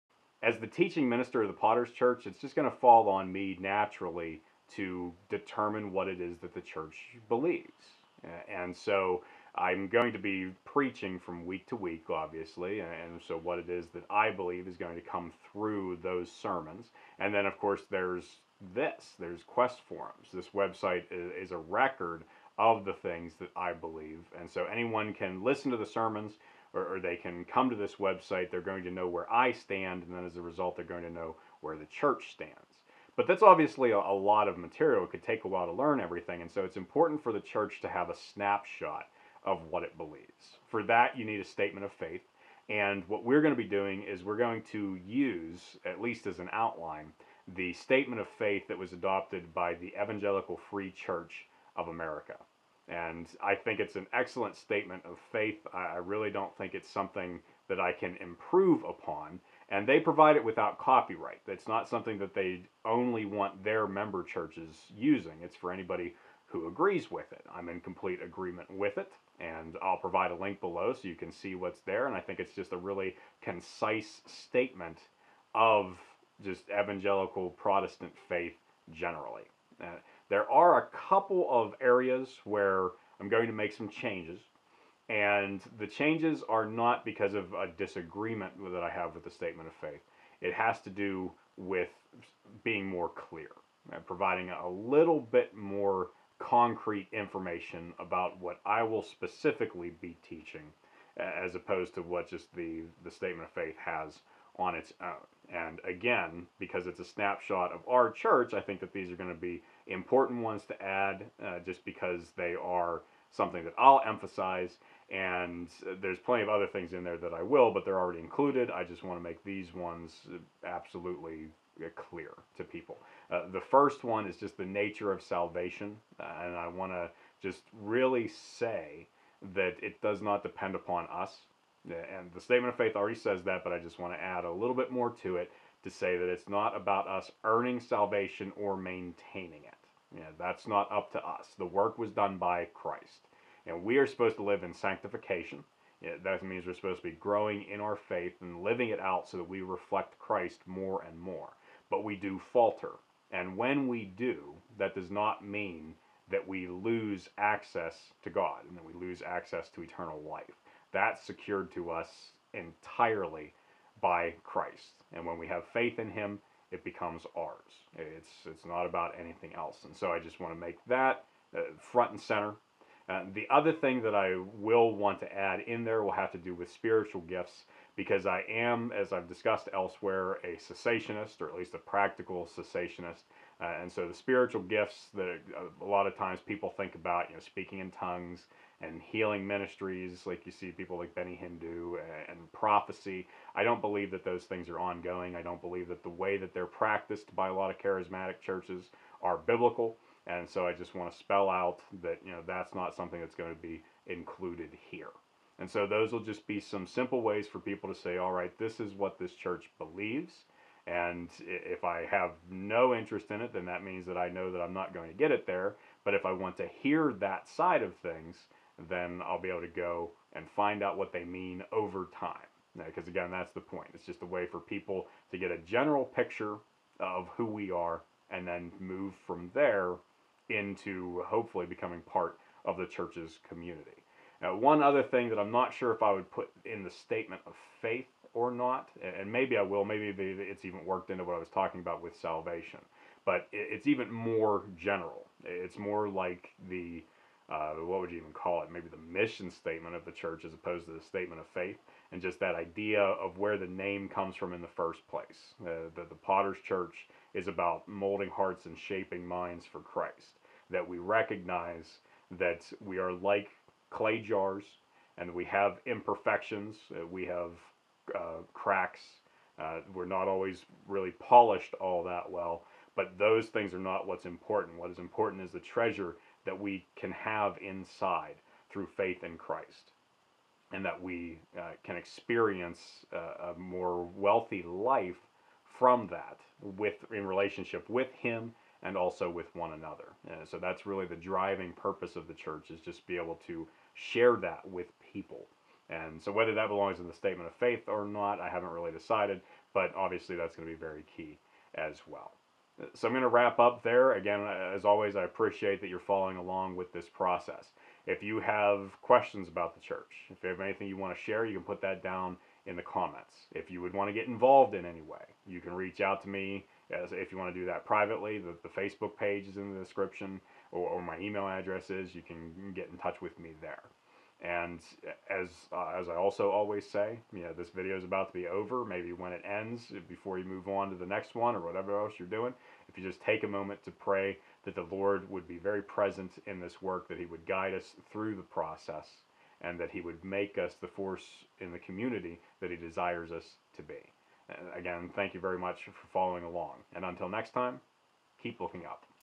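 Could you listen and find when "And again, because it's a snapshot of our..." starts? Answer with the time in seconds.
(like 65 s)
105 s.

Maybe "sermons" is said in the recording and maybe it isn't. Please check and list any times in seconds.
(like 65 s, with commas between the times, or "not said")
16 s, 25 s.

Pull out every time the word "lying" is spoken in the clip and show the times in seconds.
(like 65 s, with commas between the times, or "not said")
not said.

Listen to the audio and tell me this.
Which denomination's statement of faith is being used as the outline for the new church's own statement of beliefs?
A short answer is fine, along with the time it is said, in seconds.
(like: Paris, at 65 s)
Evangelical Free Church of America, at 50 s.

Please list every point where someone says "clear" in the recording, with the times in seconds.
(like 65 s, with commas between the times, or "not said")
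93 s, 121 s.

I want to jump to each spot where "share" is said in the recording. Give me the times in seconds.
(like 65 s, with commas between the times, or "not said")
293 s, 311 s.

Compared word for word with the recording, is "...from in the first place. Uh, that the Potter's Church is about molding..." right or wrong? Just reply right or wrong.
right.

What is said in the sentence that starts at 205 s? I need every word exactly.
And so those will just be some simple ways for people to say, all right, this is what this church believes.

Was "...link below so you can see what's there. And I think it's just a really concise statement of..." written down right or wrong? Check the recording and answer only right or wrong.
right.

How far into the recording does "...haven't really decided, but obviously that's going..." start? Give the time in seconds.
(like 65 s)
298 s.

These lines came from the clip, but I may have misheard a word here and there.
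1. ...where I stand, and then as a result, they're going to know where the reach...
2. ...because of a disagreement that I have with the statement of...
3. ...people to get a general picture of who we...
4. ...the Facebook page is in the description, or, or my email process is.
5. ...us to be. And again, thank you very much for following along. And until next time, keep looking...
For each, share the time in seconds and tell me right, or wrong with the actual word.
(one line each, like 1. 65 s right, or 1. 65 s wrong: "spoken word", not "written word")
1. 29 s wrong: "church", not "reach"
2. 87 s right
3. 224 s right
4. 318 s wrong: "address", not "process"
5. 343 s right.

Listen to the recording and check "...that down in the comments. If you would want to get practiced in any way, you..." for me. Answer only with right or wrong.
wrong.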